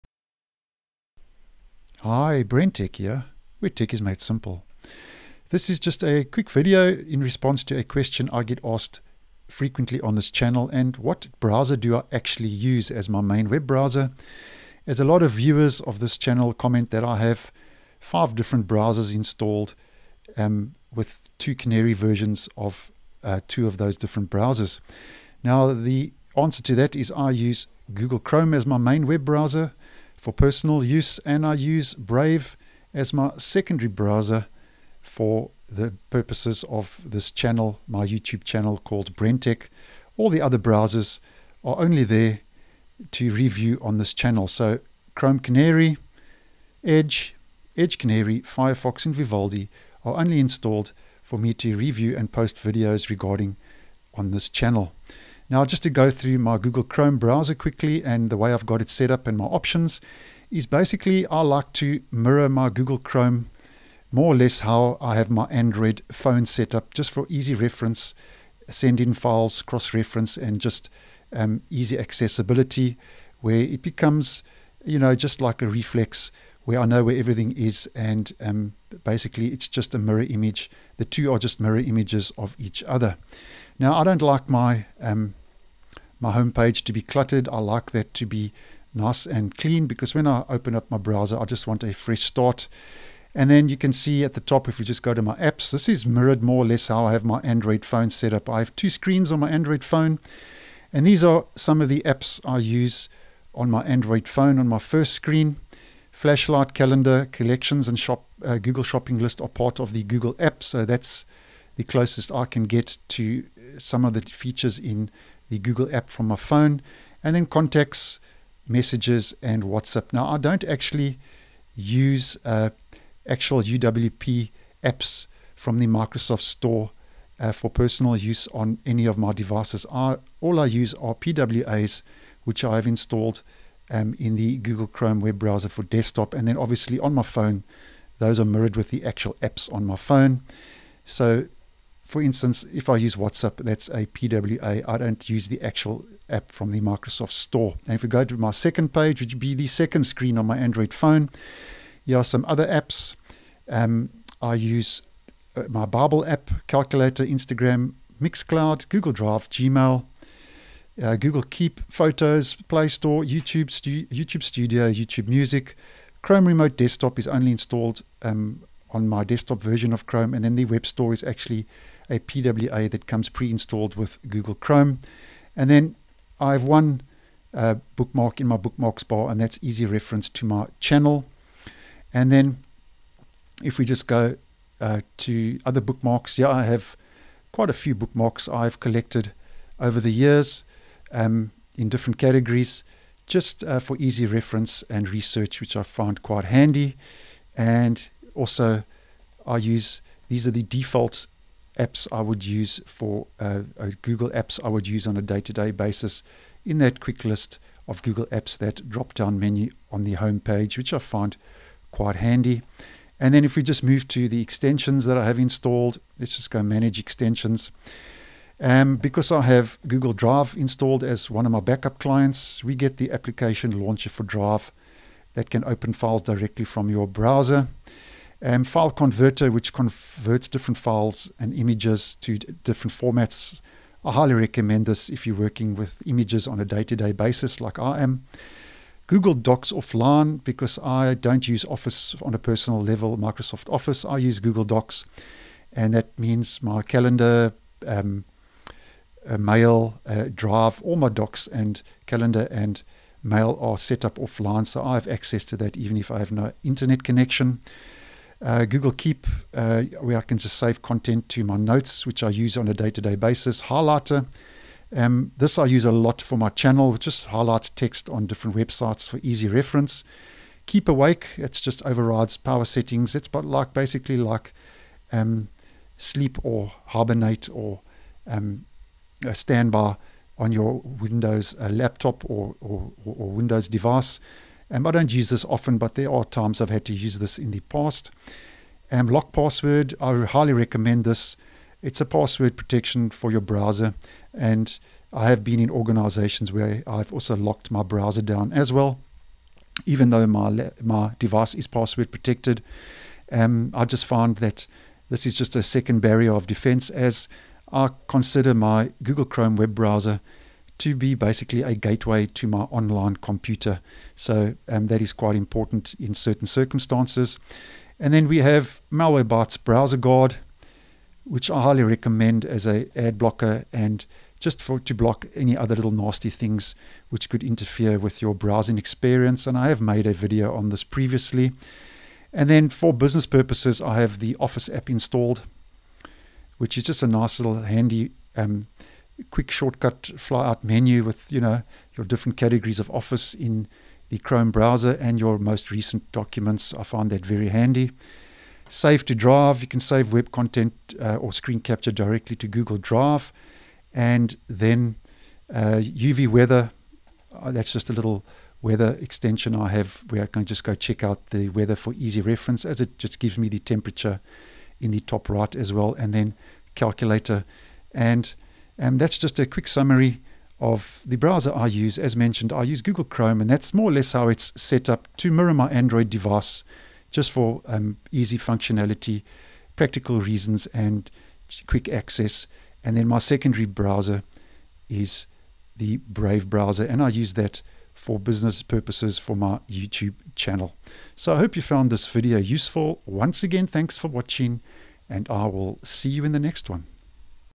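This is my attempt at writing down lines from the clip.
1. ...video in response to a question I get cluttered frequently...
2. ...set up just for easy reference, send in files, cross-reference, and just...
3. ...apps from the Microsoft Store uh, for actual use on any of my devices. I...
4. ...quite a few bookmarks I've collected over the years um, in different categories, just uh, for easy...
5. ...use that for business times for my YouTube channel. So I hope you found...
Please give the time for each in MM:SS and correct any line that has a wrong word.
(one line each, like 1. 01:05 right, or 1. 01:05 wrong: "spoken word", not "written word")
1. 00:06 wrong: "asked", not "cluttered"
2. 01:06 right
3. 02:04 wrong: "personal", not "actual"
4. 03:07 right
5. 06:27 wrong: "purposes", not "times".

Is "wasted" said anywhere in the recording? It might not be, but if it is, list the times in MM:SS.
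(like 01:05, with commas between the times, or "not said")
not said.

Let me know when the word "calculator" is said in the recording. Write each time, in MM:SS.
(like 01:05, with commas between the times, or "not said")
02:36, 06:06.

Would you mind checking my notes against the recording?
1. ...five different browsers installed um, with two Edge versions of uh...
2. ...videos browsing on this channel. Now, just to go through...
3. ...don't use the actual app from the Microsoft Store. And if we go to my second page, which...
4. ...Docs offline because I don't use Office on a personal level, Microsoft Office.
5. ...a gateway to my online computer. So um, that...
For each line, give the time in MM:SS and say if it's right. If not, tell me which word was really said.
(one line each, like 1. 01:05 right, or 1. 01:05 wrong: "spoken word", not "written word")
1. 00:17 wrong: "Canary", not "Edge"
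2. 00:52 wrong: "regarding", not "browsing"
3. 02:24 right
4. 03:59 right
5. 05:11 right.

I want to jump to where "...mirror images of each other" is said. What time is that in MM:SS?
01:21.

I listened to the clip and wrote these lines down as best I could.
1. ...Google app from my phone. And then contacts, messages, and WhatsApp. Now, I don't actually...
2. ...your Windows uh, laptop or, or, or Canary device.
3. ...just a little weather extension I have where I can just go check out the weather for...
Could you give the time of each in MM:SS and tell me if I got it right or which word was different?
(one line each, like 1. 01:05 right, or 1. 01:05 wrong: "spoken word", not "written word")
1. 01:55 right
2. 04:40 wrong: "Windows", not "Canary"
3. 05:57 right.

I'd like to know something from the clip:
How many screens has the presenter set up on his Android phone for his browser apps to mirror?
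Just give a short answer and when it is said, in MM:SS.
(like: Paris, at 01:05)
2, at 01:38.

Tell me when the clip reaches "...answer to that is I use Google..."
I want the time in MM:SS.
00:26.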